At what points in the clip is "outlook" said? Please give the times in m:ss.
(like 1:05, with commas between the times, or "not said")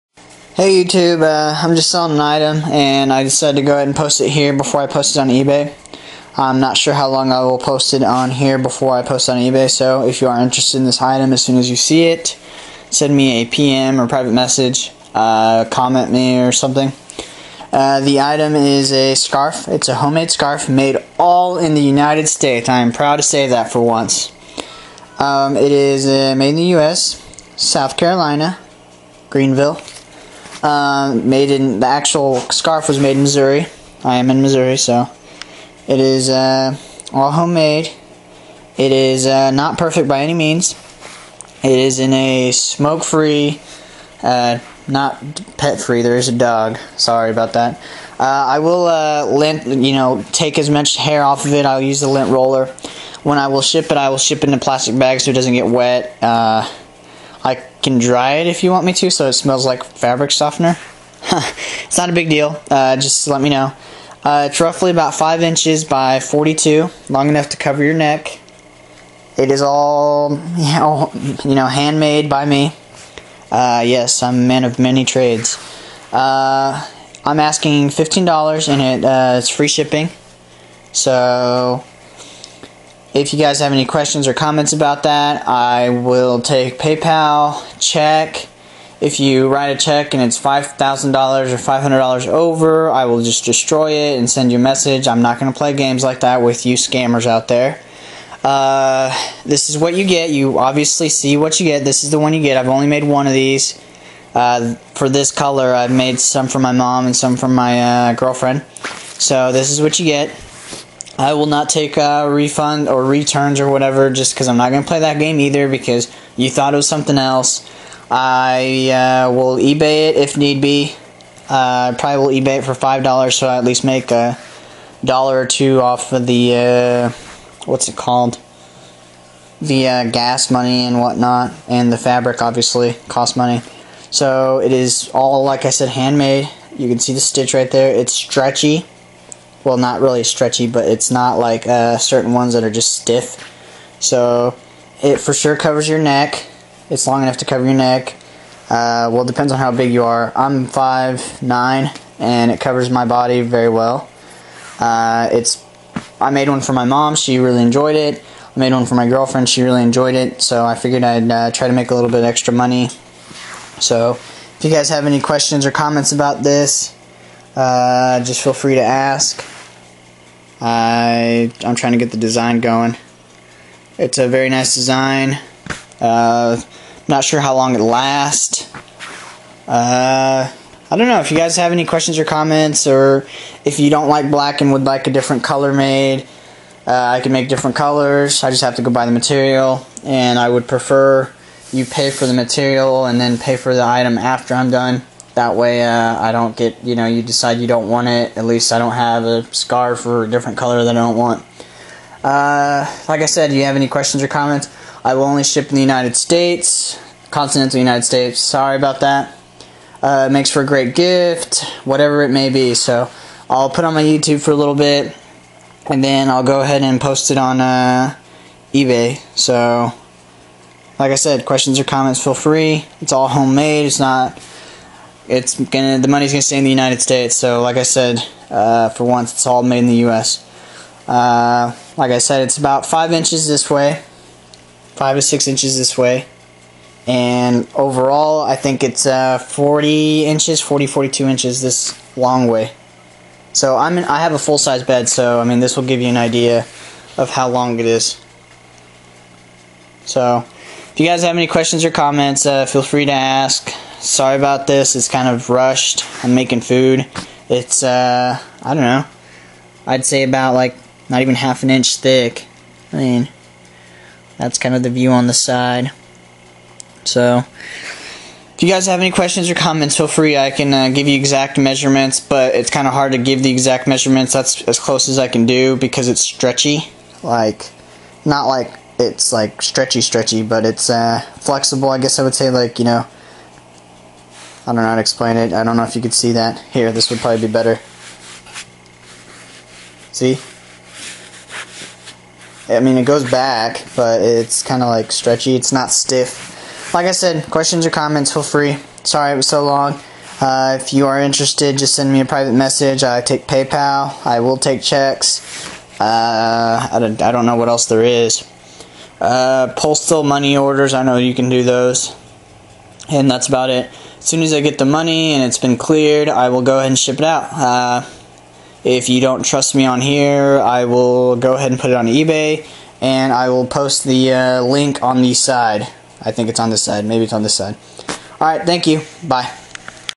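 not said.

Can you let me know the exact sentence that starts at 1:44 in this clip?
Uh, for this color, I've made some for my mom and some for my uh, girlfriend.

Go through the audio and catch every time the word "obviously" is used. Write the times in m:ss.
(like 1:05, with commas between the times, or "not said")
1:40, 2:12.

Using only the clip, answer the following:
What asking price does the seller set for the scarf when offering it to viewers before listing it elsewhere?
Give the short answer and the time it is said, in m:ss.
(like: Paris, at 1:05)
$15, at 1:17.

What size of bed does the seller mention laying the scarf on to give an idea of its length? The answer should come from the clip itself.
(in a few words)
full size.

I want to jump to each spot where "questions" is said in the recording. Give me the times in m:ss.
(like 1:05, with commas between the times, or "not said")
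1:23, 2:45, 3:01, 3:23, 3:41, 4:11, 4:29, 4:57.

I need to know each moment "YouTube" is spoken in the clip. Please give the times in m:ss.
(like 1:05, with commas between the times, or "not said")
0:00, 3:34.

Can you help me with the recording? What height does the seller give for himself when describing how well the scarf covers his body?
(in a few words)
5'9".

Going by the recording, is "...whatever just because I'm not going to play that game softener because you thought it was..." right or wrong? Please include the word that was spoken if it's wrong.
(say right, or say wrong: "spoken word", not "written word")
wrong: "either", not "softener".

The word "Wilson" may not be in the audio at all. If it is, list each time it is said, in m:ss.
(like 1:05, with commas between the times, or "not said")
not said.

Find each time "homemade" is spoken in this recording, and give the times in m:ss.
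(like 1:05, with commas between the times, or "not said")
0:19, 0:37, 3:43.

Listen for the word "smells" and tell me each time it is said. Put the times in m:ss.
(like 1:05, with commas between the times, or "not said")
0:59.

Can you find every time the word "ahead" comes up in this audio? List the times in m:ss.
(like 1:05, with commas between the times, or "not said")
0:03, 3:36, 5:16, 5:21.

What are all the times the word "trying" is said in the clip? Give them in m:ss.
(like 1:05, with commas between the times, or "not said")
2:51.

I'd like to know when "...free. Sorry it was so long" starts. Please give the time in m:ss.
4:58.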